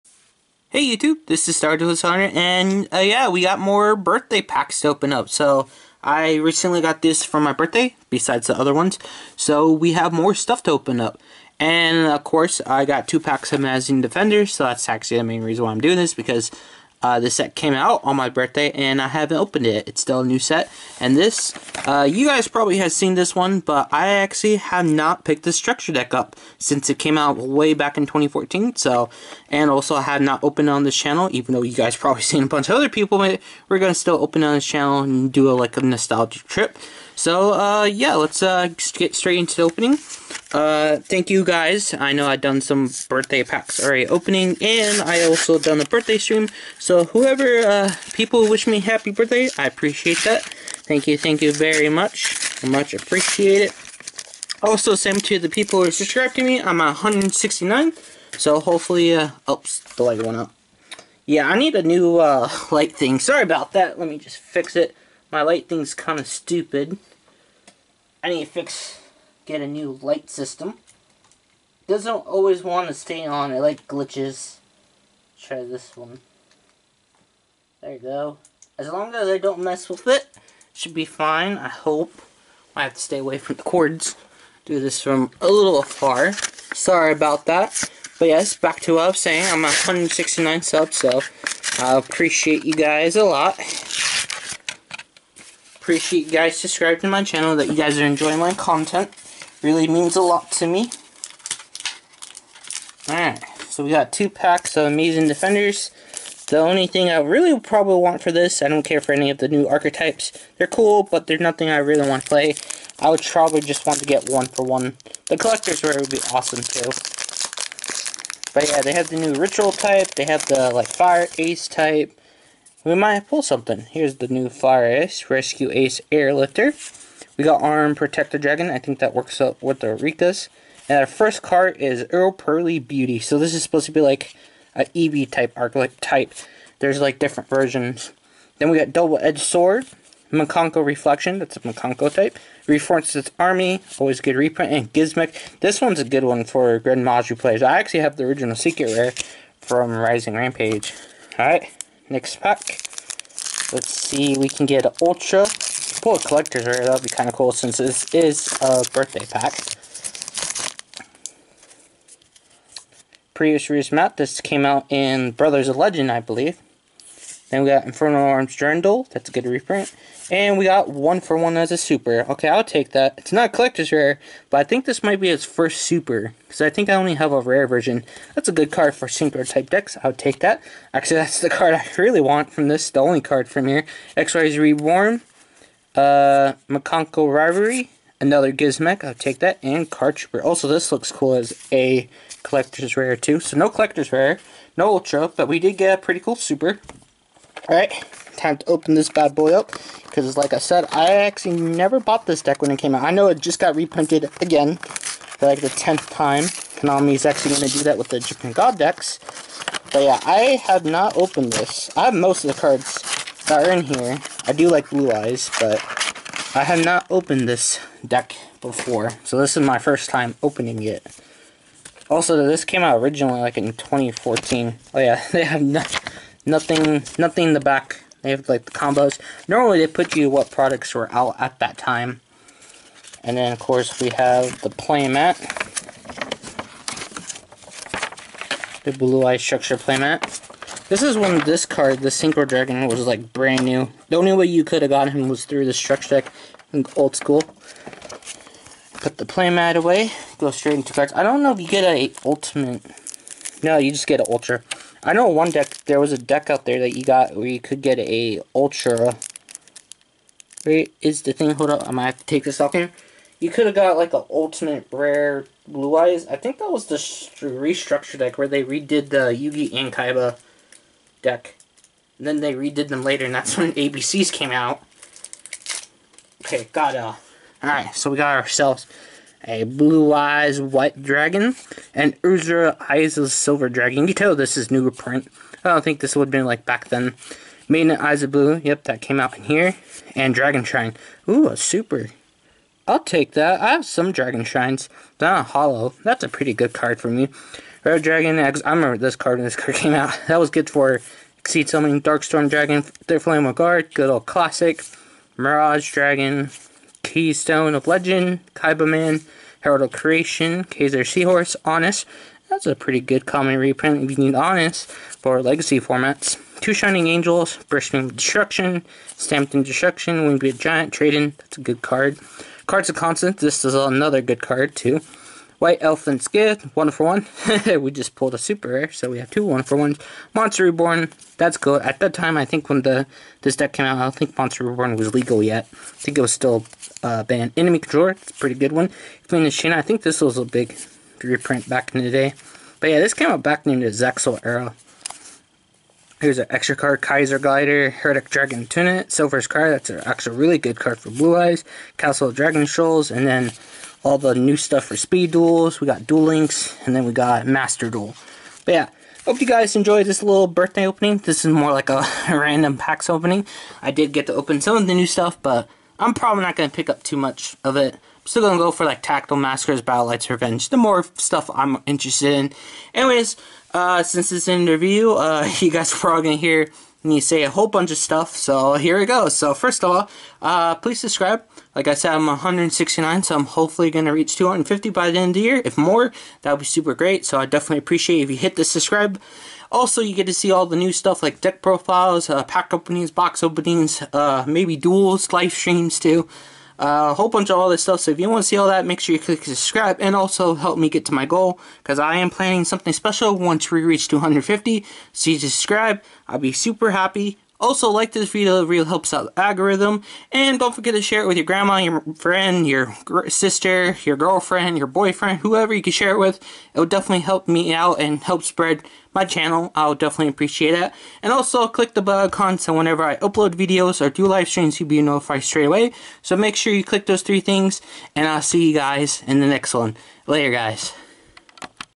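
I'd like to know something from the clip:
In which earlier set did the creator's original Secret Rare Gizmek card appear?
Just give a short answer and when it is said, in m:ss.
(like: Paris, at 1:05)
Rising Rampage, at 2:29.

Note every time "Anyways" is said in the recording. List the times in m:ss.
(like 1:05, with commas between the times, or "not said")
6:12.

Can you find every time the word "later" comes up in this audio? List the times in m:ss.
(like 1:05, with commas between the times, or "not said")
4:33, 7:10.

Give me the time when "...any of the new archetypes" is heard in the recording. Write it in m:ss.
1:49.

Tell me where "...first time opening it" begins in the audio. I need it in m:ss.
3:39.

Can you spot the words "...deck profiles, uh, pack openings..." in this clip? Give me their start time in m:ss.
6:31.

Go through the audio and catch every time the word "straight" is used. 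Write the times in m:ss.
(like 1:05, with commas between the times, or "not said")
0:39, 4:10, 7:05.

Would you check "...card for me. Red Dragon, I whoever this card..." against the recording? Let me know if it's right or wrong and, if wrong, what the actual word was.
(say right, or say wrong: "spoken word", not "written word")
wrong: "remember", not "whoever".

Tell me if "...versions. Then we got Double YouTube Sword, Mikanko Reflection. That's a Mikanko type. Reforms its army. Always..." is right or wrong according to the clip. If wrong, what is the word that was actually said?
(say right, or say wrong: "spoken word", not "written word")
wrong: "Edged", not "YouTube".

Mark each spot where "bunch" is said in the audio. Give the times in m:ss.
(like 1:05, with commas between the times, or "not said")
0:32, 6:17, 6:37.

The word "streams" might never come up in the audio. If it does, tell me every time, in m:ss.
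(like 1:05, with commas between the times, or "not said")
0:46, 6:35, 7:04.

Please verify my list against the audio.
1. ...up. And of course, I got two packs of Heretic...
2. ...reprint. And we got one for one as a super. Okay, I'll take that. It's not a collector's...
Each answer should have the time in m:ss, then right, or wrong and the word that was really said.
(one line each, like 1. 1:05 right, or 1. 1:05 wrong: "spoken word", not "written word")
1. 0:11 wrong: "Amazing", not "Heretic"
2. 2:49 right.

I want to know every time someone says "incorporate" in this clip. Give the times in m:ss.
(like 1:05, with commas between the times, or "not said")
not said.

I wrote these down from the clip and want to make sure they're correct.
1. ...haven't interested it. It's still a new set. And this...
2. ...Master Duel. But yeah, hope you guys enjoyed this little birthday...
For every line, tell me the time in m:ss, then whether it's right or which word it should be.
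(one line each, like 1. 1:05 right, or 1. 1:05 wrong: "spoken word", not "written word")
1. 0:19 wrong: "opened", not "interested"
2. 5:57 right.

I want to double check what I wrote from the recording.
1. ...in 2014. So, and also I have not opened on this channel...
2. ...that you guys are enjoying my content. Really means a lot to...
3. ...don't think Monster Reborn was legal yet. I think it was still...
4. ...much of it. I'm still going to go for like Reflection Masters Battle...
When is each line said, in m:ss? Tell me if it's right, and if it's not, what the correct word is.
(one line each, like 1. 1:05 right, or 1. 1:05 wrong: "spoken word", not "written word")
1. 0:27 right
2. 1:37 right
3. 5:34 right
4. 6:07 wrong: "Tactical", not "Reflection".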